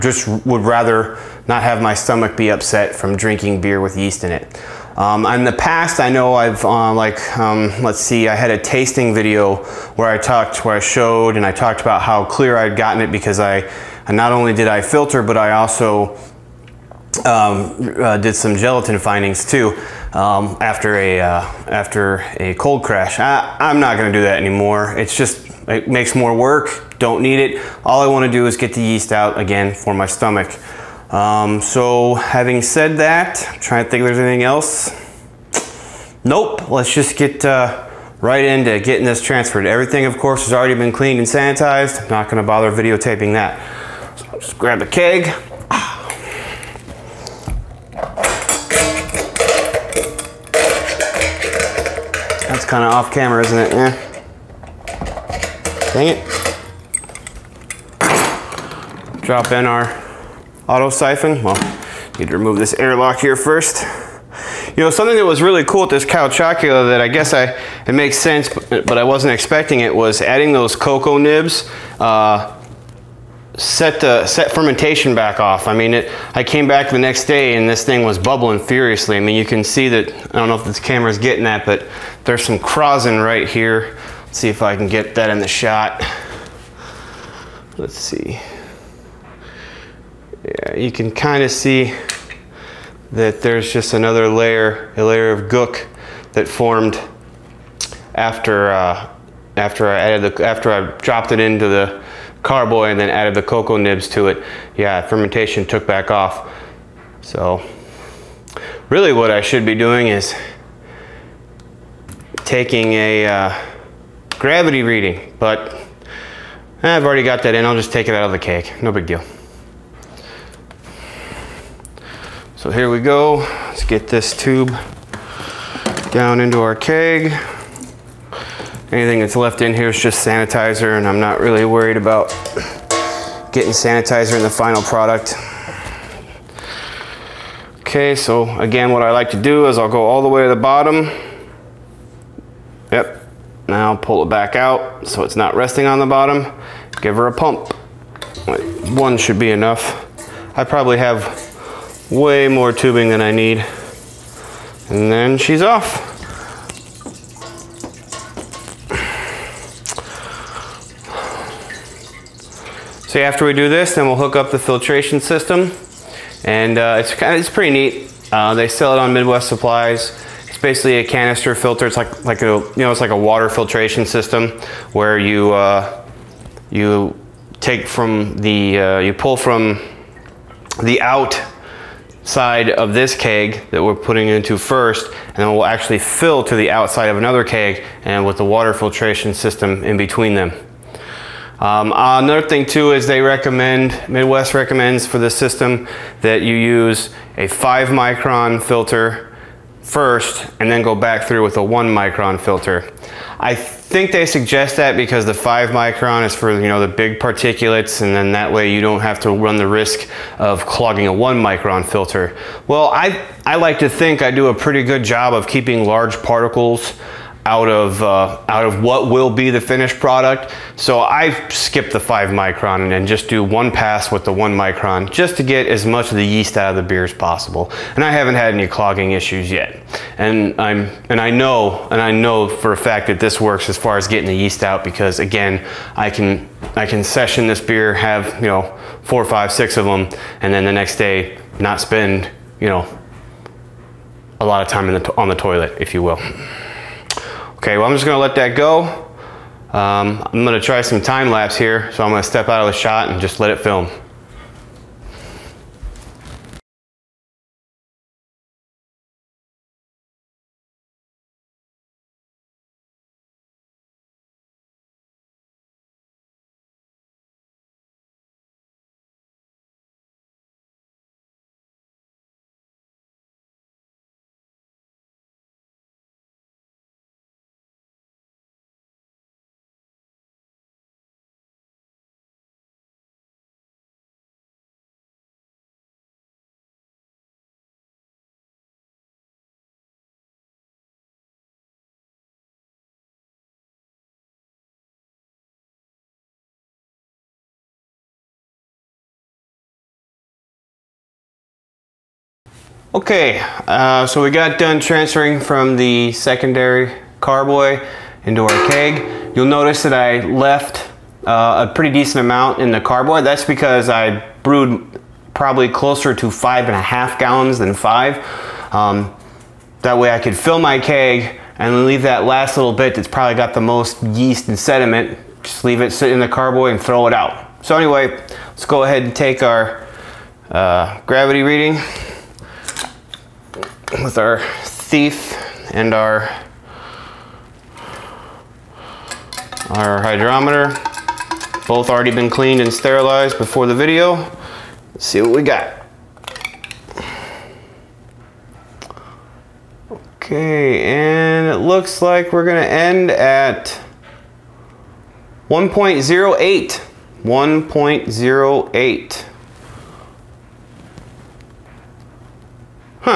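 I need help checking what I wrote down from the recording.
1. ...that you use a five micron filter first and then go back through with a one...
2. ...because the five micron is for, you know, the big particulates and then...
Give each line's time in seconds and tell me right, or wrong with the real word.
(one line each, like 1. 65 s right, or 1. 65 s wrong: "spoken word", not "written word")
1. 196 s right
2. 204 s right.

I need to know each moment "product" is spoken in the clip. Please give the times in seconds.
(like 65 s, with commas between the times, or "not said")
134 s, 219 s.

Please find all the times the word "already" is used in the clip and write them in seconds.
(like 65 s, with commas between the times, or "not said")
40 s, 117 s, 341 s.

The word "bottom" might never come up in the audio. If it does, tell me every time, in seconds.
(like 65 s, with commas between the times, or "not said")
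140 s, 146 s.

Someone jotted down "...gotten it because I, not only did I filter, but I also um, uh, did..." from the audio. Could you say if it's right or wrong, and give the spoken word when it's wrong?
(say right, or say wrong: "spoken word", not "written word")
right.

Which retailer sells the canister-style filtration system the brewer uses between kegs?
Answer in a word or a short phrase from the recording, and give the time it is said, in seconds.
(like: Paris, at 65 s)
Midwest Supplies, at 169 s.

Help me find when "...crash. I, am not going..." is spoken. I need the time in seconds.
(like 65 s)
22 s.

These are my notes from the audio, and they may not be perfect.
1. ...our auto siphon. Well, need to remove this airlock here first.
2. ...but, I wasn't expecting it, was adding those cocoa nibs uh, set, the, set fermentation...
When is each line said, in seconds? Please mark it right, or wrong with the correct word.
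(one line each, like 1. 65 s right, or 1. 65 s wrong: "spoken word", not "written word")
1. 59 s right
2. 68 s right.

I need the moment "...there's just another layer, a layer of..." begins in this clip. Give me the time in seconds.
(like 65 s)
93 s.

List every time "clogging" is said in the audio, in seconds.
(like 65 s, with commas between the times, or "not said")
210 s, 228 s.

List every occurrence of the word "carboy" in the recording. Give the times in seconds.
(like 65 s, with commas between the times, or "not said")
102 s, 307 s, 312 s, 326 s.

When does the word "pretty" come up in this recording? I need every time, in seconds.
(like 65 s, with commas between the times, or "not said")
167 s, 214 s, 311 s.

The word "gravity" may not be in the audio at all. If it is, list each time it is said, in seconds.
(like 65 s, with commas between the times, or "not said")
114 s, 331 s.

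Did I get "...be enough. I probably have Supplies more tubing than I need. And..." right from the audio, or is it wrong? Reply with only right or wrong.
wrong.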